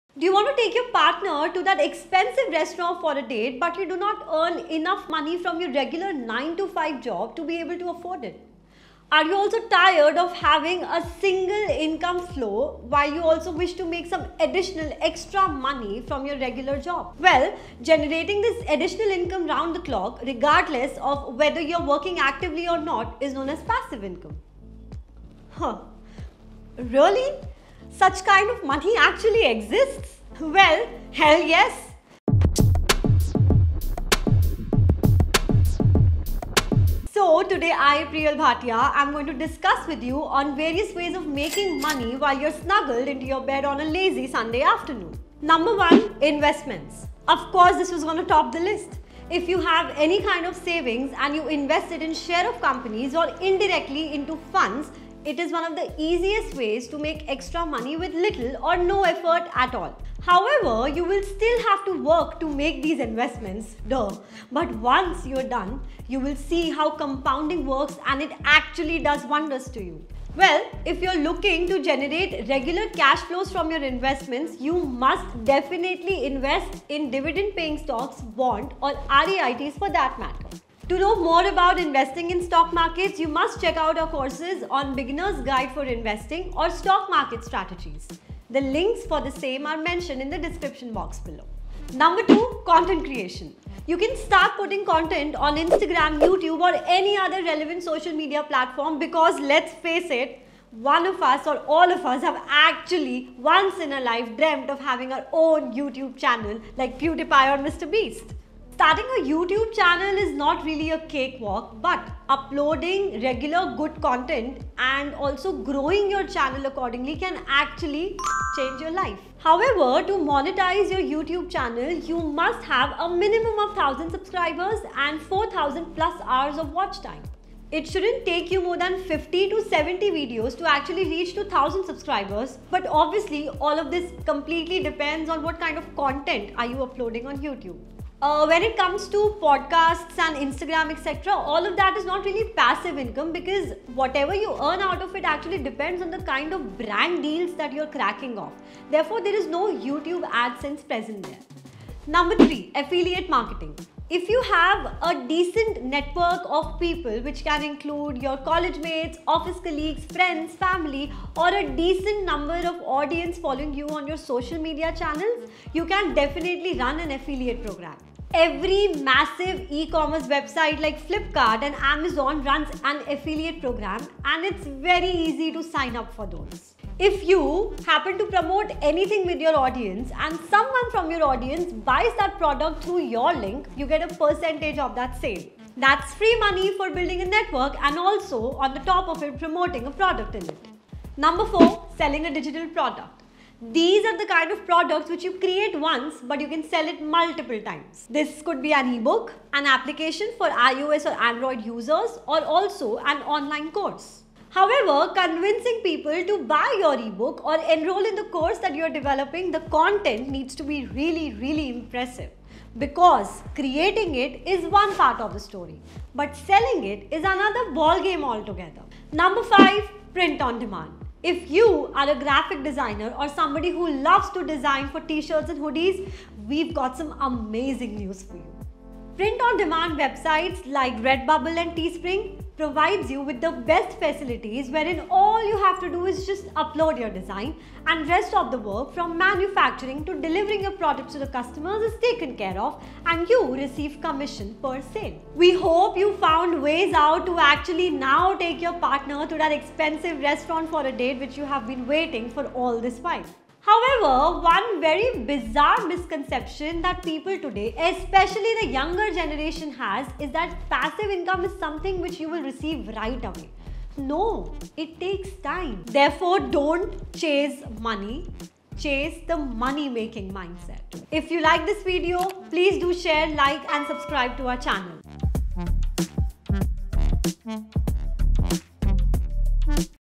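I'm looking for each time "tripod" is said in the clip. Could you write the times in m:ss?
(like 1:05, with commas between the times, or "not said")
not said.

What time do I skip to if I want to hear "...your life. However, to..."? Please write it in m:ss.
1:58.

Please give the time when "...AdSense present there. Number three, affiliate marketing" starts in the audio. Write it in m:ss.
2:30.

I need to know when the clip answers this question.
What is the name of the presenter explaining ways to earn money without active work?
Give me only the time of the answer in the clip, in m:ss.
0:38.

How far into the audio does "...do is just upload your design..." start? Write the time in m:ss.
3:55.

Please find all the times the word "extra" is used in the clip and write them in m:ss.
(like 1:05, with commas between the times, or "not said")
0:15, 0:57.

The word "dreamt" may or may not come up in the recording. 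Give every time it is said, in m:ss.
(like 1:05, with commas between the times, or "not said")
1:44.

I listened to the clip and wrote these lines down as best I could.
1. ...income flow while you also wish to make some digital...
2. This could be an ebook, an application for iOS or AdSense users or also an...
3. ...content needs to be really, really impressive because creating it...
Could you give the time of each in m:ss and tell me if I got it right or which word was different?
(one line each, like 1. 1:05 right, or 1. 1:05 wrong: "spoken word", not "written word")
1. 0:11 wrong: "additional", not "digital"
2. 3:18 wrong: "Android", not "AdSense"
3. 3:29 right.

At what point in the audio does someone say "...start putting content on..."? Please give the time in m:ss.
1:34.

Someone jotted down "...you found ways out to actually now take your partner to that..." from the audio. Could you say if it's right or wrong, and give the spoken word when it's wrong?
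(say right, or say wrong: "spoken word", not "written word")
right.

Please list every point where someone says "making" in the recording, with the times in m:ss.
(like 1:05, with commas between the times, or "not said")
0:41, 4:29.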